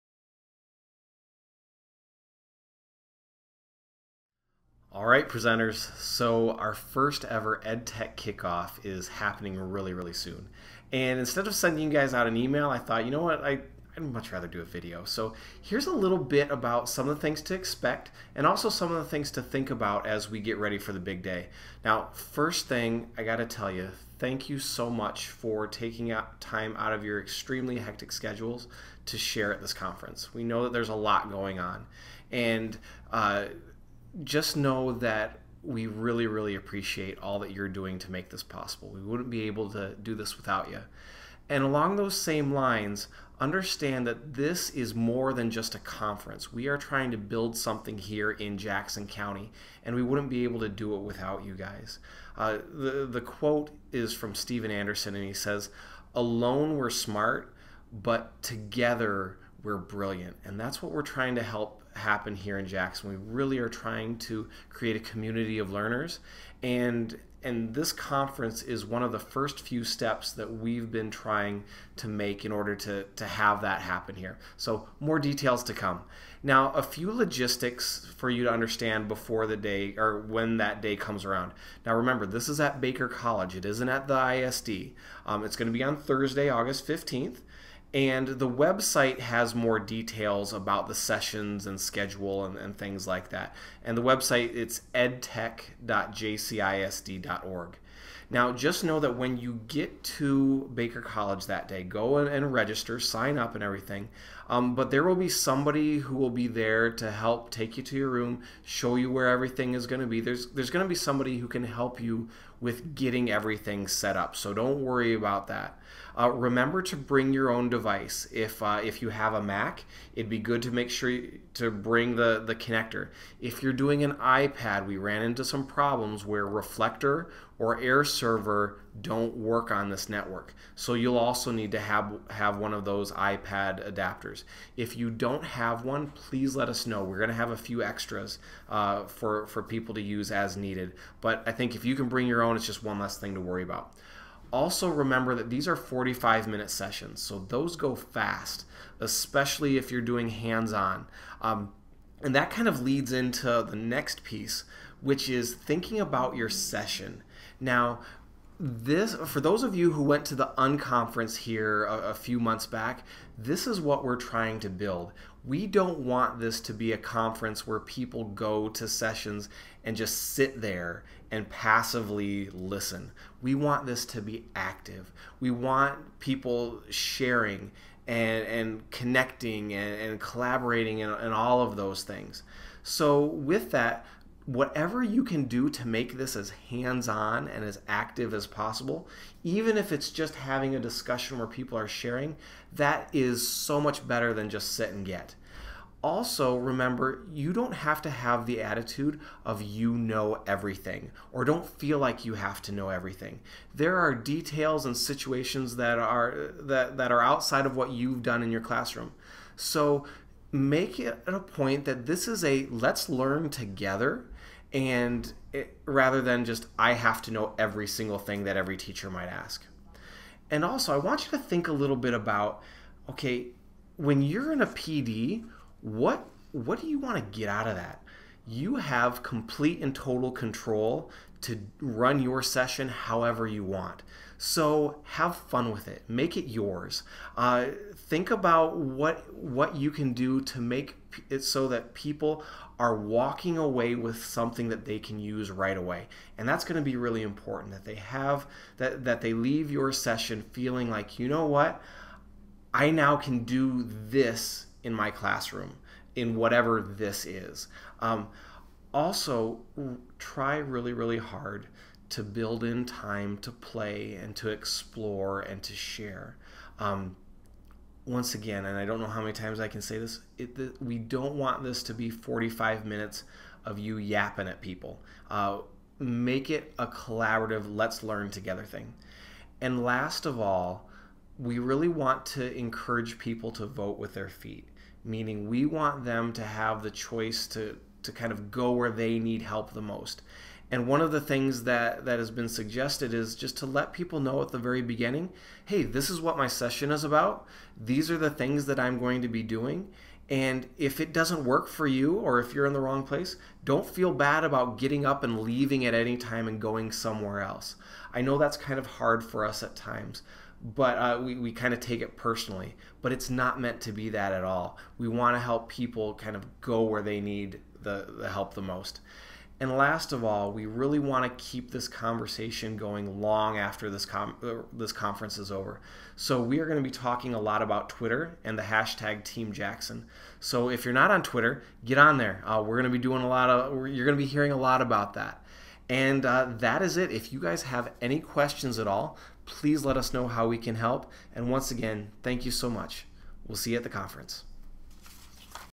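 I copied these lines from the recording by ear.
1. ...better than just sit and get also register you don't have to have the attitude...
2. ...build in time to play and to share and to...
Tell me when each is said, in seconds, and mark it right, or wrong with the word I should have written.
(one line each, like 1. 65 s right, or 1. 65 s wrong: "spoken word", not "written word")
1. 194 s wrong: "remember", not "register"
2. 262 s wrong: "explore", not "share".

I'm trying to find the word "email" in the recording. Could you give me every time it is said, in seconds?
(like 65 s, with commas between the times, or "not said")
12 s.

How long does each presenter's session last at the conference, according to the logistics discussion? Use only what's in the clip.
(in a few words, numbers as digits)
45 minutes.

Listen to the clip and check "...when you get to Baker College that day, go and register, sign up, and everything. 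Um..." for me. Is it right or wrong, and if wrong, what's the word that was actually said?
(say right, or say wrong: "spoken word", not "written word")
right.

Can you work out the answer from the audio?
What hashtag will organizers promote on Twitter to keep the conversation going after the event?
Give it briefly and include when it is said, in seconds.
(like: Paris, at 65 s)
Team Jackson, at 329 s.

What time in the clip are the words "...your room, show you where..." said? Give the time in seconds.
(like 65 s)
107 s.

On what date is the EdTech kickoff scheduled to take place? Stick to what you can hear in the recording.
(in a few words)
Thursday, August 15th.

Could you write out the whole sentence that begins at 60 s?
And that's what we're trying to help happen here in Jackson.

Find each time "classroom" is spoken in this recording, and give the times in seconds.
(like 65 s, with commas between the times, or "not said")
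208 s, 255 s.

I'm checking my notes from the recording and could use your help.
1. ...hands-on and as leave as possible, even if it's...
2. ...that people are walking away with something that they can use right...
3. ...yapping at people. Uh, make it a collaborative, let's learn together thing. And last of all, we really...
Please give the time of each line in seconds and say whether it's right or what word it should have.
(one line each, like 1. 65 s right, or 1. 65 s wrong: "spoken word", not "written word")
1. 186 s wrong: "active", not "leave"
2. 241 s right
3. 273 s right.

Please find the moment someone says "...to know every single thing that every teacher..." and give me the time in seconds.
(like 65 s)
217 s.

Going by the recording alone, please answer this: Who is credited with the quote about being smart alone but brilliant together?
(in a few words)
Steven Anderson.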